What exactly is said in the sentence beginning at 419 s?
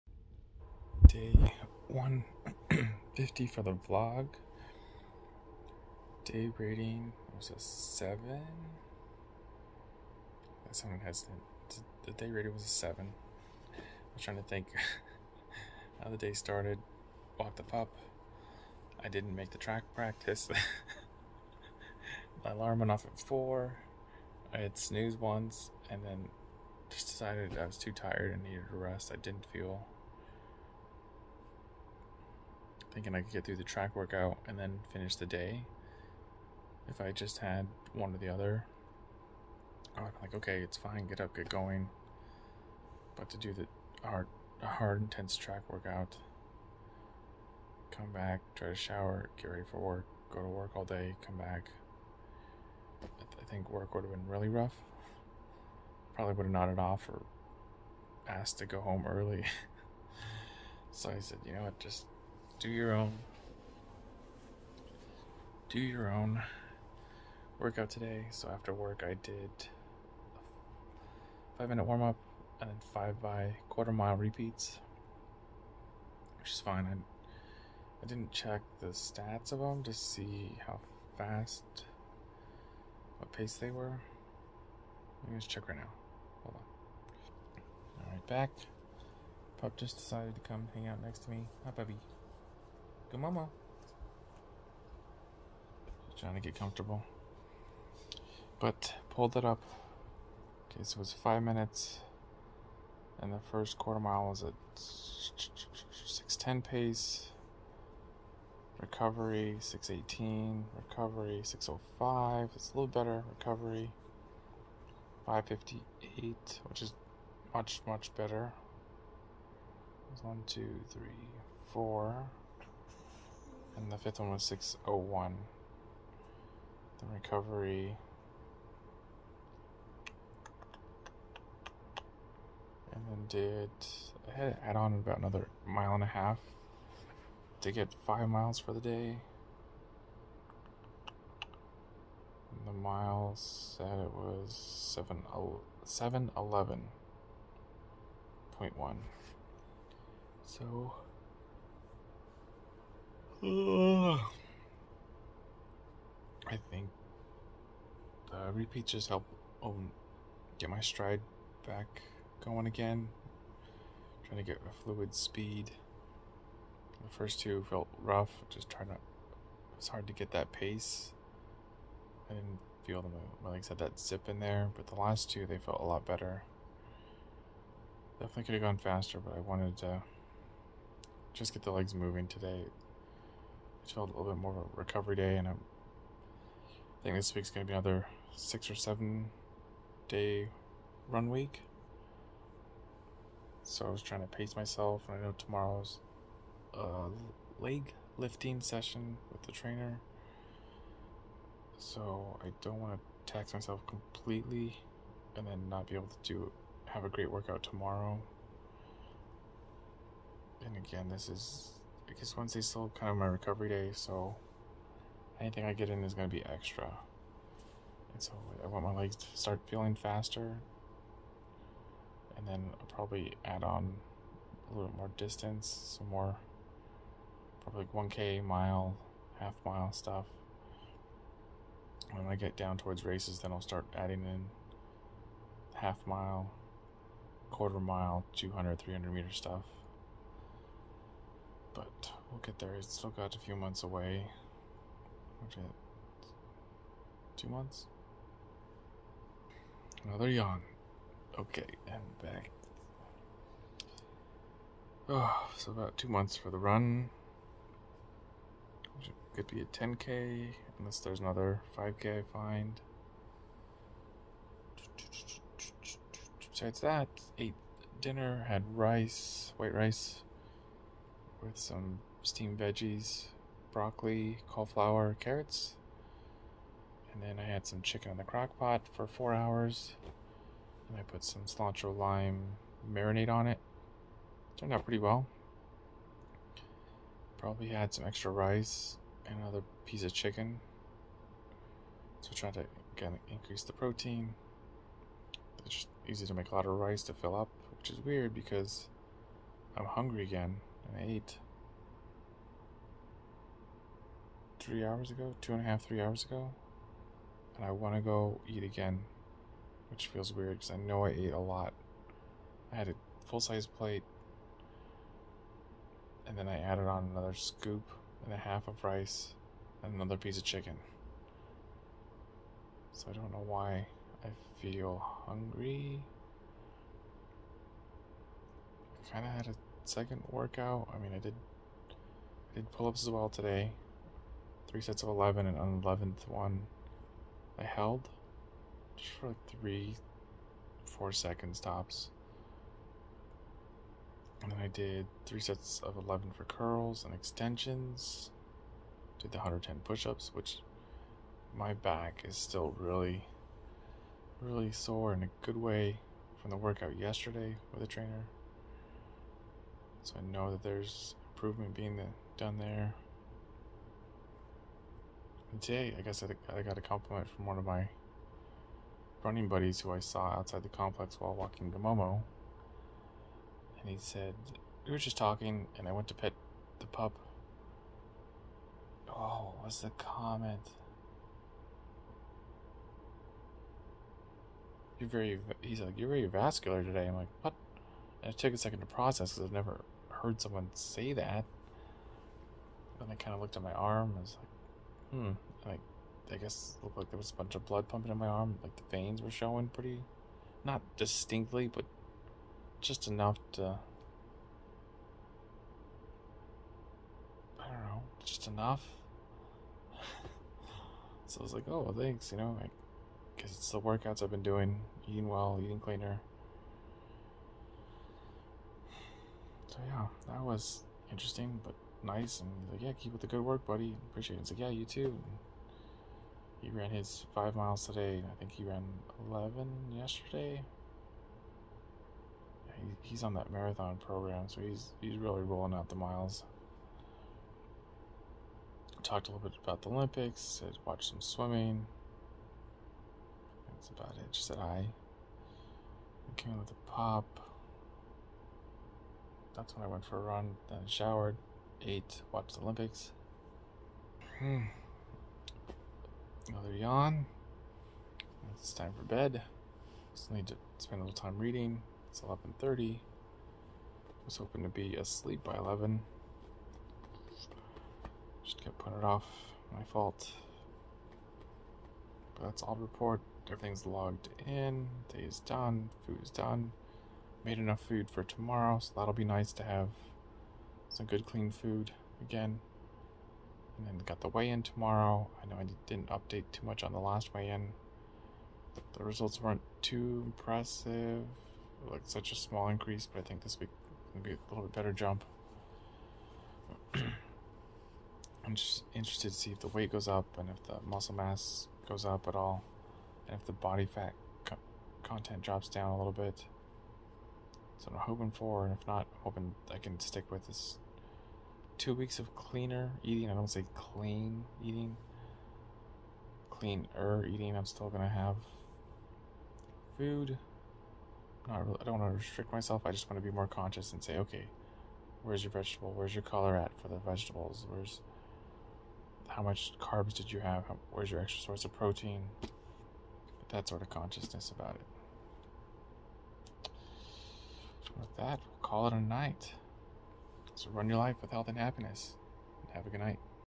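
yeah, that was interesting but nice.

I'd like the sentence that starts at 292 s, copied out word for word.
So trying to again increase the protein.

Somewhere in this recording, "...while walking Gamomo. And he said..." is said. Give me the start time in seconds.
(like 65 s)
371 s.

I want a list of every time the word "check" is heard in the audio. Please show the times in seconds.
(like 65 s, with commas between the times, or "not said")
78 s, 85 s.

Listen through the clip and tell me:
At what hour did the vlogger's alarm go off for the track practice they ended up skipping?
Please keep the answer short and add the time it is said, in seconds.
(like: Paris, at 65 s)
4, at 22 s.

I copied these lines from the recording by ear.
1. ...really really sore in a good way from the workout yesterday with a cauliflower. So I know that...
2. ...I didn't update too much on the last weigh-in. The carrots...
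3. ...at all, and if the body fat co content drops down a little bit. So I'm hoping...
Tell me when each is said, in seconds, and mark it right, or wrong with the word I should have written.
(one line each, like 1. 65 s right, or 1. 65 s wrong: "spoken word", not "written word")
1. 352 s wrong: "trainer", not "cauliflower"
2. 485 s wrong: "results", not "carrots"
3. 502 s right.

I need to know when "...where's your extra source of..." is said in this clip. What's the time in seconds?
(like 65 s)
530 s.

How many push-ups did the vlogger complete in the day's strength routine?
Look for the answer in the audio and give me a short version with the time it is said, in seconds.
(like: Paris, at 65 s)
110, at 349 s.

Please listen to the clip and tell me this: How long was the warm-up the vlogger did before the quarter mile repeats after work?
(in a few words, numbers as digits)
5 minutes.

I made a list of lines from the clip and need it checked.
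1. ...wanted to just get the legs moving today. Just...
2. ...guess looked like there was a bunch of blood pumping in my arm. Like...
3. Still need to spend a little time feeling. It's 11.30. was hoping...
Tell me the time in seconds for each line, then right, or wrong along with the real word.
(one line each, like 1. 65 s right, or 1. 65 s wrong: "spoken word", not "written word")
1. 179 s right
2. 396 s right
3. 460 s wrong: "reading", not "feeling".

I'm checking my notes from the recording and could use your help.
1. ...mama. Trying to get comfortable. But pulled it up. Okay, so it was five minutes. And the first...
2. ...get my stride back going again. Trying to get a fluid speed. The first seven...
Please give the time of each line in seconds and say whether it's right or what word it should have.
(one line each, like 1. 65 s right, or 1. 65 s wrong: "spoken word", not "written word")
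1. 93 s right
2. 160 s wrong: "two", not "seven".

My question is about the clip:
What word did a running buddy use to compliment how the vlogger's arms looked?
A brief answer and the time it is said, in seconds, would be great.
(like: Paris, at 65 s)
vascular, at 386 s.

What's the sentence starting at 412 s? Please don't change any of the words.
You know, like, because it's the workouts I've been doing, eating well, eating cleaner.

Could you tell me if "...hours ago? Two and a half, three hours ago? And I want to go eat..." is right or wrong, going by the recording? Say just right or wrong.
right.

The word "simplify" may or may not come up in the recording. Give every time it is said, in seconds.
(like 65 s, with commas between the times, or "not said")
not said.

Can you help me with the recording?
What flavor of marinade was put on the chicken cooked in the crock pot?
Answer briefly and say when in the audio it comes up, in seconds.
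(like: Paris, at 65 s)
cilantro lime, at 281 s.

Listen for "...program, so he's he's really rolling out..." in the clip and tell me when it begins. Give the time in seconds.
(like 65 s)
433 s.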